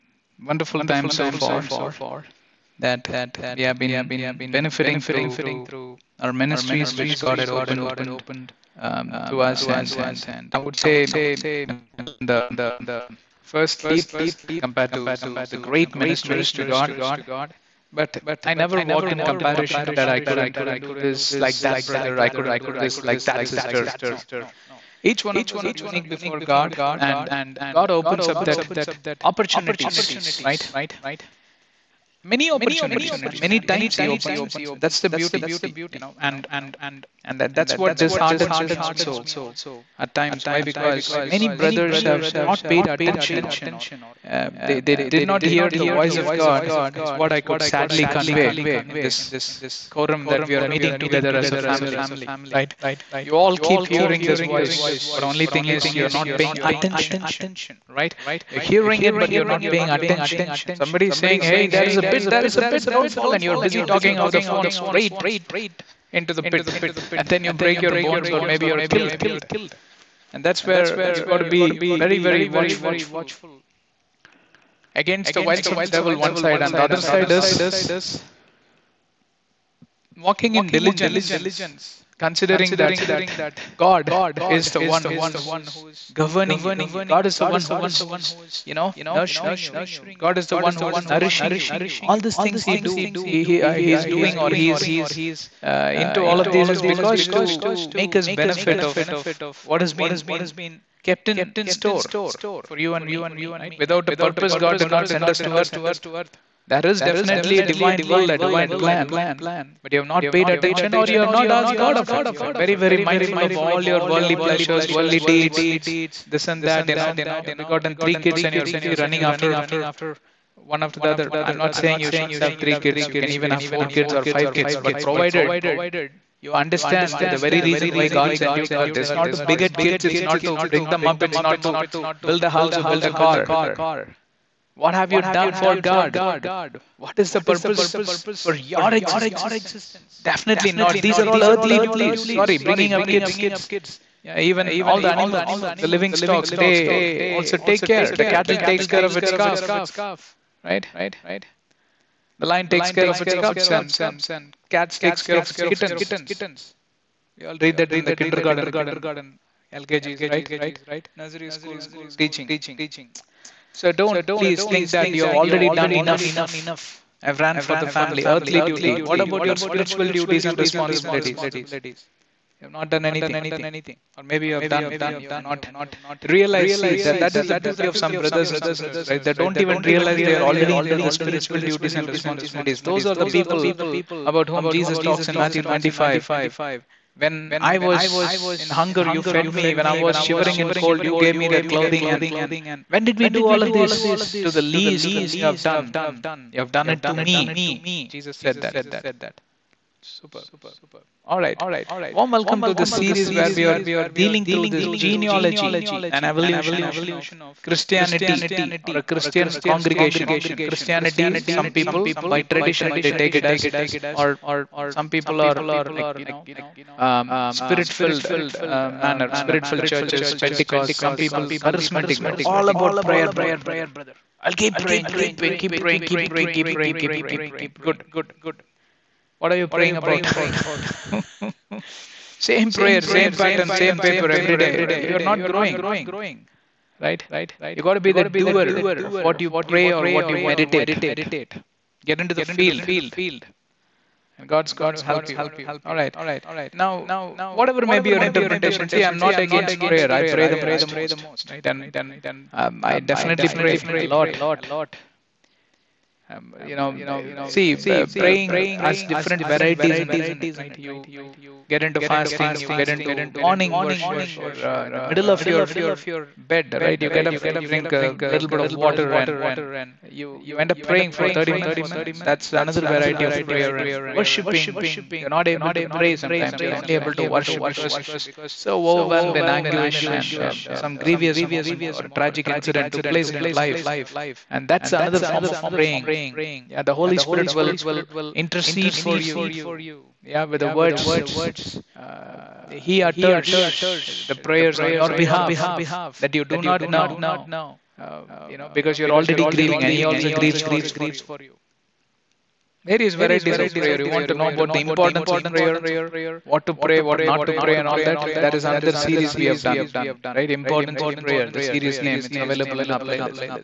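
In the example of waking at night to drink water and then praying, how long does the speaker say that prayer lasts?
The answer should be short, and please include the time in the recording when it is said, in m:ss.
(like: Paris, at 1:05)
30 minutes, at 4:31.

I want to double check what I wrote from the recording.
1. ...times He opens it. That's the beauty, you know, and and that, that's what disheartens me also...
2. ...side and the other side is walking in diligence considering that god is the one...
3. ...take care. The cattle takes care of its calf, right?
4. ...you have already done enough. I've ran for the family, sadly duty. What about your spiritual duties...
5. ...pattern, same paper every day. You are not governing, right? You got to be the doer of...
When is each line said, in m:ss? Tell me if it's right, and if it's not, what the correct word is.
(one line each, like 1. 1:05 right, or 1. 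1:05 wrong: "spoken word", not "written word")
1. 0:33 right
2. 1:16 right
3. 2:27 right
4. 2:45 wrong: "earthly", not "sadly"
5. 3:53 wrong: "growing", not "governing".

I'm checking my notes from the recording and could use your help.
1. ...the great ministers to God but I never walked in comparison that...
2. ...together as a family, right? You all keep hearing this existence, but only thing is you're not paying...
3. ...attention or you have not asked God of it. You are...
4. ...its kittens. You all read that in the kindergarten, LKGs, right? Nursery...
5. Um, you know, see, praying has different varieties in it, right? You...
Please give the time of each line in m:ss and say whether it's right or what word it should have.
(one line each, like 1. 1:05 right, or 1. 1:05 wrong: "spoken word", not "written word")
1. 0:15 right
2. 0:50 wrong: "voice", not "existence"
3. 1:50 right
4. 2:35 right
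5. 4:16 right.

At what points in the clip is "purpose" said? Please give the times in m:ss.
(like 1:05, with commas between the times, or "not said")
1:44, 2:17.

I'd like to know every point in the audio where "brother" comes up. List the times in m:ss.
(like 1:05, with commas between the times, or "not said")
0:21, 0:41, 2:58, 3:43.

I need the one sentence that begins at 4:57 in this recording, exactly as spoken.
Uh, you know, because you're already grieving, and He also grieves for you various varieties of prayer.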